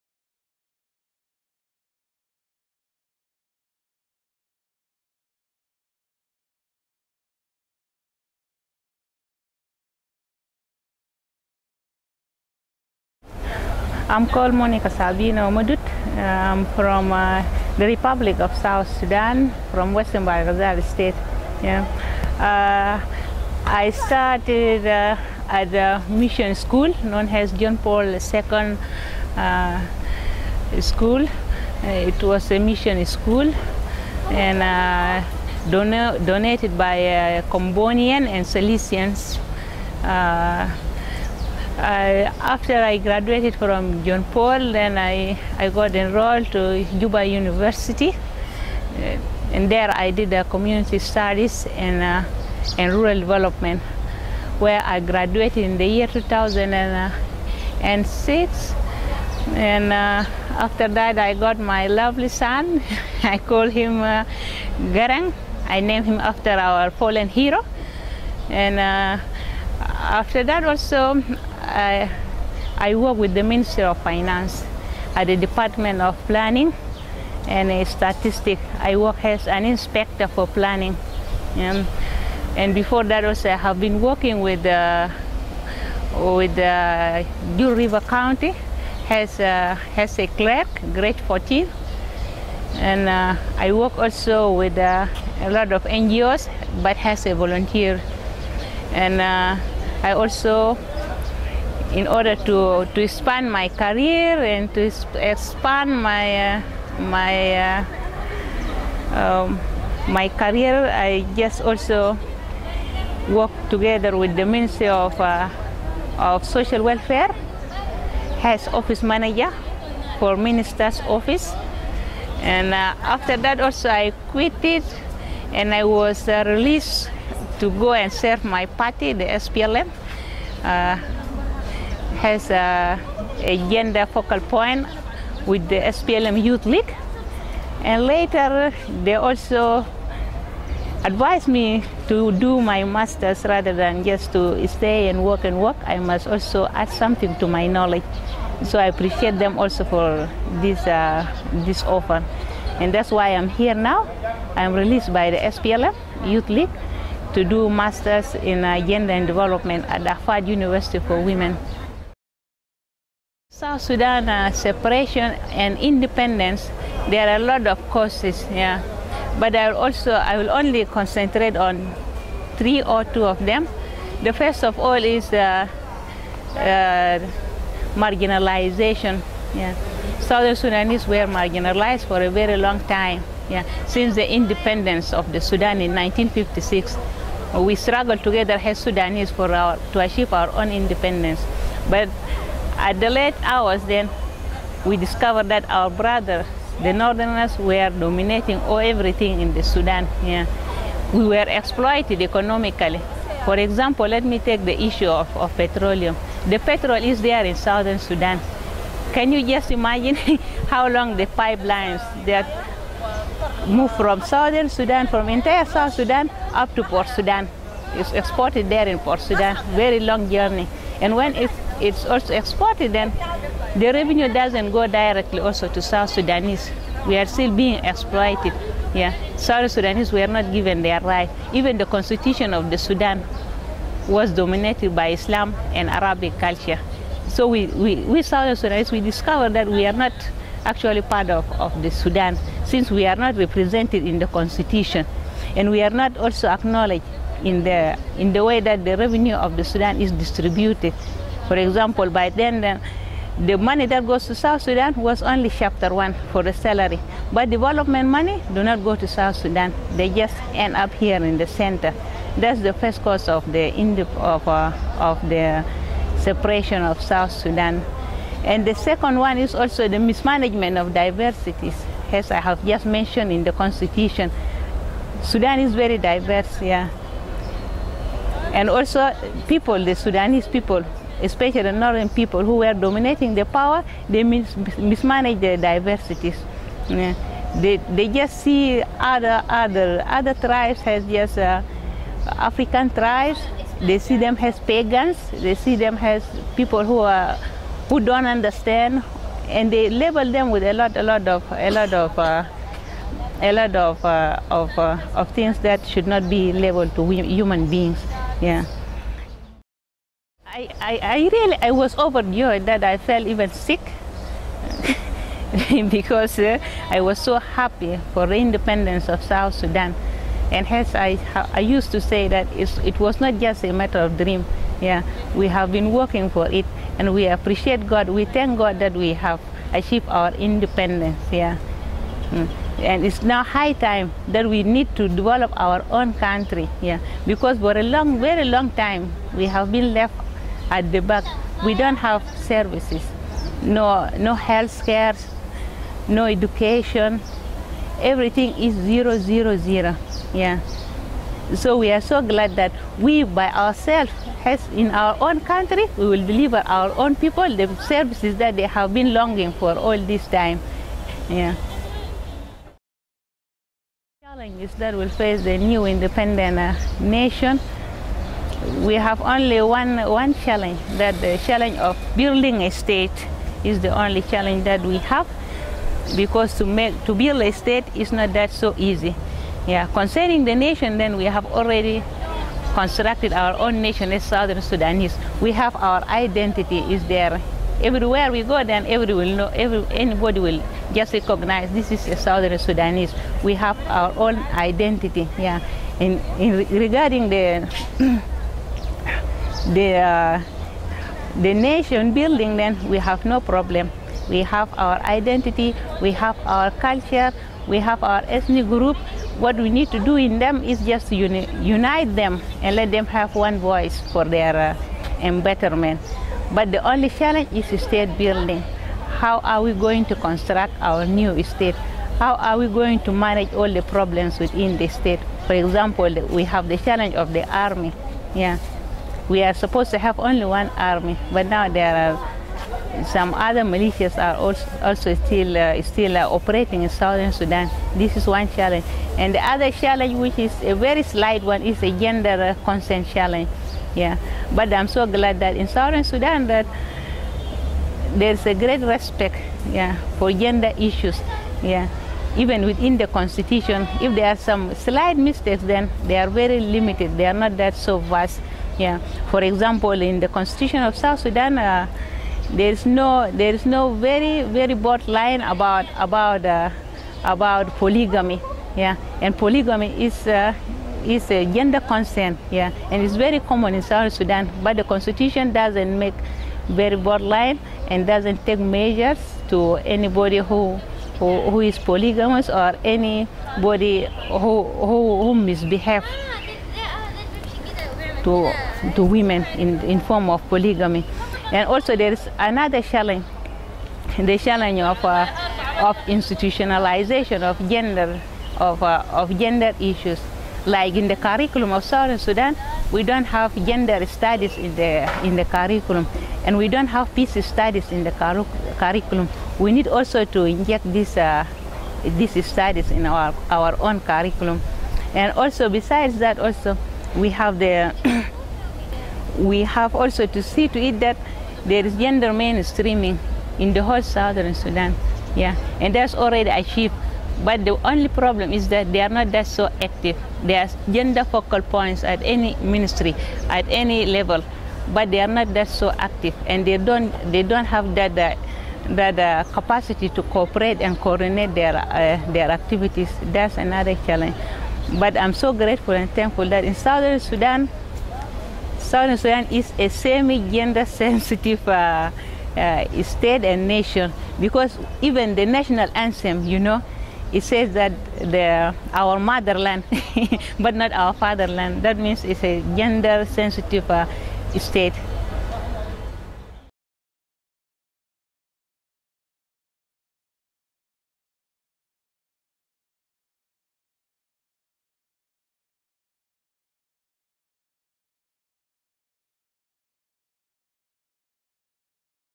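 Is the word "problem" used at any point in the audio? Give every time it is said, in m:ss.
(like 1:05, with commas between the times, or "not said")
6:43, 7:03, 8:48.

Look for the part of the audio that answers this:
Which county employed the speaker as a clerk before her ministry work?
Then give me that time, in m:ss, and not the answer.
1:27.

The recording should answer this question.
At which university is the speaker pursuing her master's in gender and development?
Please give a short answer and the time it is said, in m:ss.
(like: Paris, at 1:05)
Ahfad University for Women, at 2:40.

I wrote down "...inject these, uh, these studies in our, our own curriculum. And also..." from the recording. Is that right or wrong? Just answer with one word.
right.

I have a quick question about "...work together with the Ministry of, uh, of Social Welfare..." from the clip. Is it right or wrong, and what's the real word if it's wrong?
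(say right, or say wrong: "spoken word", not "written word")
right.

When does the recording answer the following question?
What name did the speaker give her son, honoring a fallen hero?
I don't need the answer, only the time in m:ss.
1:04.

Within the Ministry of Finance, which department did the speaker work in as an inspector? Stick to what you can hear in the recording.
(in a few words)
Department of Planning and Statistics.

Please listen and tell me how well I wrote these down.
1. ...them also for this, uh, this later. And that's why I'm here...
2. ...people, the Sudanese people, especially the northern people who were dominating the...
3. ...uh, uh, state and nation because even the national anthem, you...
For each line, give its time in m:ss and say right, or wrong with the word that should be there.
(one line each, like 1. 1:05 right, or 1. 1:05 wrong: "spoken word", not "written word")
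1. 2:29 wrong: "offer", not "later"
2. 4:39 right
3. 9:11 right.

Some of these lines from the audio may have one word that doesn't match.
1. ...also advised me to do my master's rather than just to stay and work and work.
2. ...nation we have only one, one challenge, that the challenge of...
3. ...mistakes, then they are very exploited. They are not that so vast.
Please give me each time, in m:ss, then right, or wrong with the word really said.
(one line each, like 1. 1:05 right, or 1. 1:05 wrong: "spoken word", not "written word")
1. 2:19 right
2. 6:07 right
3. 7:35 wrong: "limited", not "exploited".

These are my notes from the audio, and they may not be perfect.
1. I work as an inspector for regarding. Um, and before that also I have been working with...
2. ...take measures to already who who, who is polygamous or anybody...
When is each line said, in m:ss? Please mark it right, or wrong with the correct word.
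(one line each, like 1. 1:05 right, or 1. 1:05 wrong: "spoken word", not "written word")
1. 1:18 wrong: "planning", not "regarding"
2. 7:58 wrong: "anybody", not "already".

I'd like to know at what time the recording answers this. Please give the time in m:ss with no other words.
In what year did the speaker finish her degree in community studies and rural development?
0:56.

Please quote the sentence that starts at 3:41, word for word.
And when it's it's also exported, then the revenue doesn't go directly also to South Sudanese.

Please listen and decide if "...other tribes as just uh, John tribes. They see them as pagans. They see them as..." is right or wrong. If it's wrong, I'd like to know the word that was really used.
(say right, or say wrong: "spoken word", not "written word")
wrong: "African", not "John".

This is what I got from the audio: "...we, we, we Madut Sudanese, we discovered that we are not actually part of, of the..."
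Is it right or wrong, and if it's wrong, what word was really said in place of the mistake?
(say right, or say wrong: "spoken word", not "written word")
wrong: "South", not "Madut".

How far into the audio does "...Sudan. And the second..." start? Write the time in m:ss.
4:27.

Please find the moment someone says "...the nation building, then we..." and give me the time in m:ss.
6:41.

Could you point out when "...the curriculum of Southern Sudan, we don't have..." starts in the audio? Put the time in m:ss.
8:21.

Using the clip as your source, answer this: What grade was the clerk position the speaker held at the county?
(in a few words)
14.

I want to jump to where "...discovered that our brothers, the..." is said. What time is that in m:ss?
3:14.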